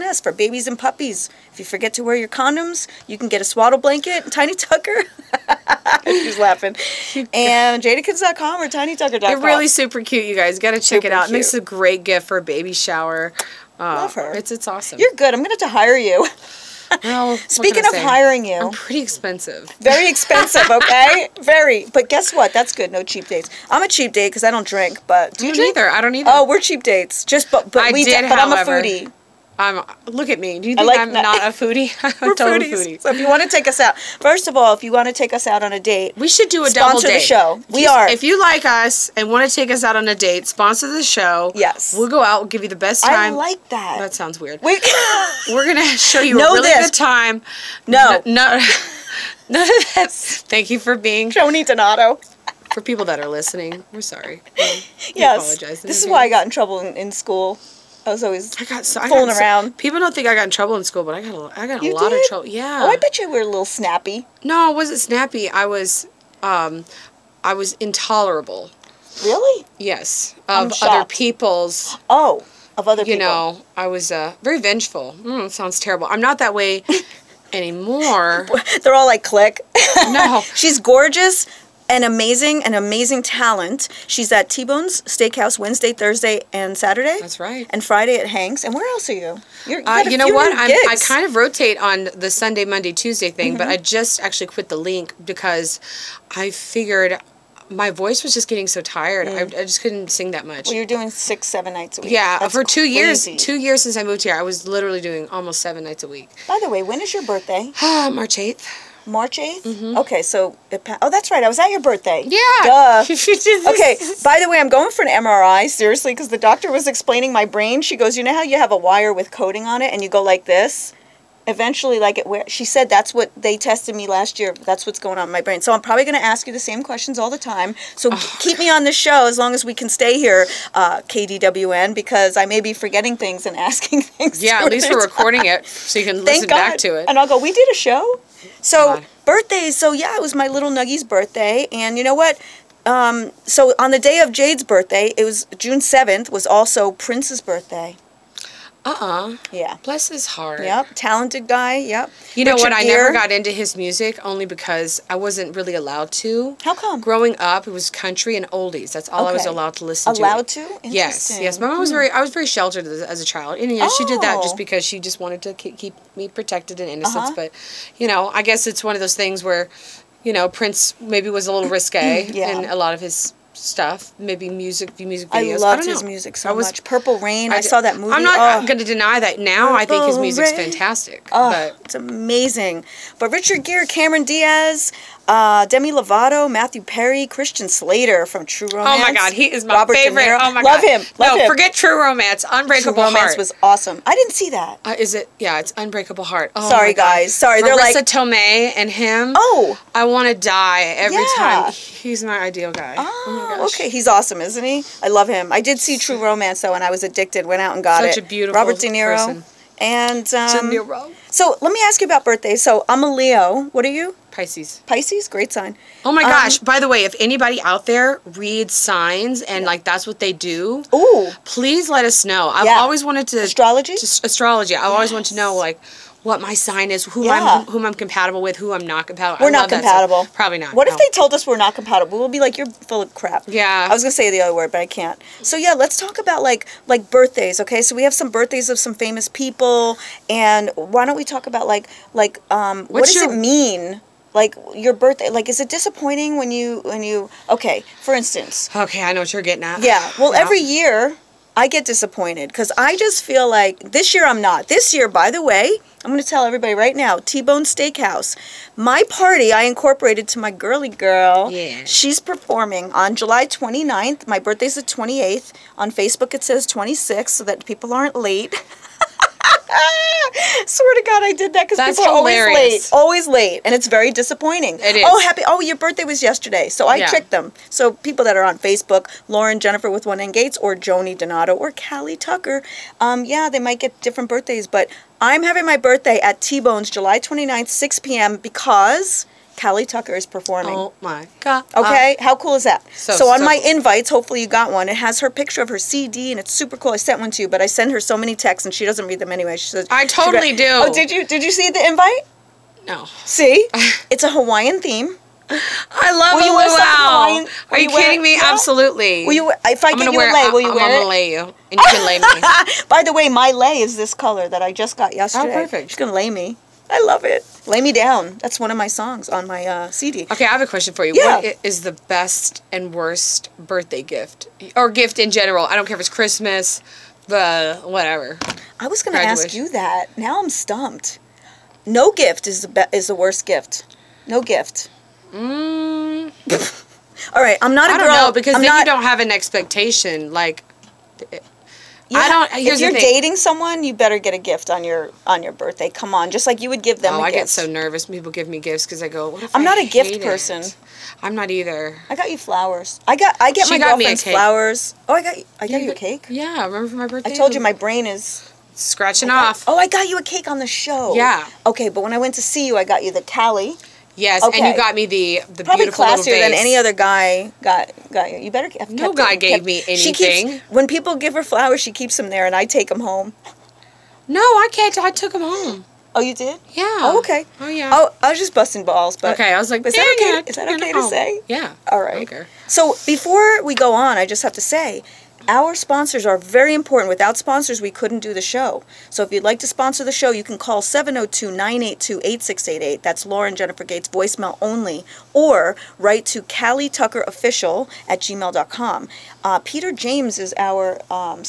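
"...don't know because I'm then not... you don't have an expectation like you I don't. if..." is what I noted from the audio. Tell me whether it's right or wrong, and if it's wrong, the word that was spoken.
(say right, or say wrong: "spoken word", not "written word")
right.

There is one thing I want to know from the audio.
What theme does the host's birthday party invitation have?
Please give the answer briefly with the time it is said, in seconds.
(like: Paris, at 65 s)
Hawaiian, at 304 s.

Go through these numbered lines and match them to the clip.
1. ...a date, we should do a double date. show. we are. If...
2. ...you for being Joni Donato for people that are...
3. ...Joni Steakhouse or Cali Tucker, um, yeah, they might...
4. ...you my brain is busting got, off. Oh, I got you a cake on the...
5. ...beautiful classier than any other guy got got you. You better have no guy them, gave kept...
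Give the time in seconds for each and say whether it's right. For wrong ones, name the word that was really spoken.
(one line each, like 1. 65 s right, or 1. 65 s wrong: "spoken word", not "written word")
1. 35 s right
2. 50 s right
3. 280 s wrong: "Donato", not "Steakhouse"
4. 357 s wrong: "scratching", not "busting"
5. 365 s right.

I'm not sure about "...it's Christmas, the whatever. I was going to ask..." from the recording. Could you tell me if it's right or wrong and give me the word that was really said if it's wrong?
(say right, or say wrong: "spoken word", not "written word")
right.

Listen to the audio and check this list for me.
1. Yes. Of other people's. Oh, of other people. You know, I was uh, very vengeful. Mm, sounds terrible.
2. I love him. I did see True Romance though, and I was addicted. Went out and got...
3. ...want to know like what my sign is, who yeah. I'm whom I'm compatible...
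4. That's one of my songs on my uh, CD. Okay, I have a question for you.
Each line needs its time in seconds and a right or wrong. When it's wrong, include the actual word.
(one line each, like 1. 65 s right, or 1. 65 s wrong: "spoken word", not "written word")
1. 69 s right
2. 205 s right
3. 225 s right
4. 318 s right.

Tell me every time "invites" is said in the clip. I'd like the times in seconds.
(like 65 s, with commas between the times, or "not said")
293 s, 301 s.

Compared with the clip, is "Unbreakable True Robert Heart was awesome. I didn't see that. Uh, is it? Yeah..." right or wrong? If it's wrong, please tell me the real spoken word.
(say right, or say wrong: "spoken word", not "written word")
wrong: "Romance", not "Robert".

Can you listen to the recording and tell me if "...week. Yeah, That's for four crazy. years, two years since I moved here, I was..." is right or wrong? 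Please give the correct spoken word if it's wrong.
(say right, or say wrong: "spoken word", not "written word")
wrong: "two", not "four".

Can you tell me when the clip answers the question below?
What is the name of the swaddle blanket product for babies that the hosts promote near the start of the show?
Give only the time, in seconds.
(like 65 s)
4 s.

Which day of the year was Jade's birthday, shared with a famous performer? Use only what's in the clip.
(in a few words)
June 7.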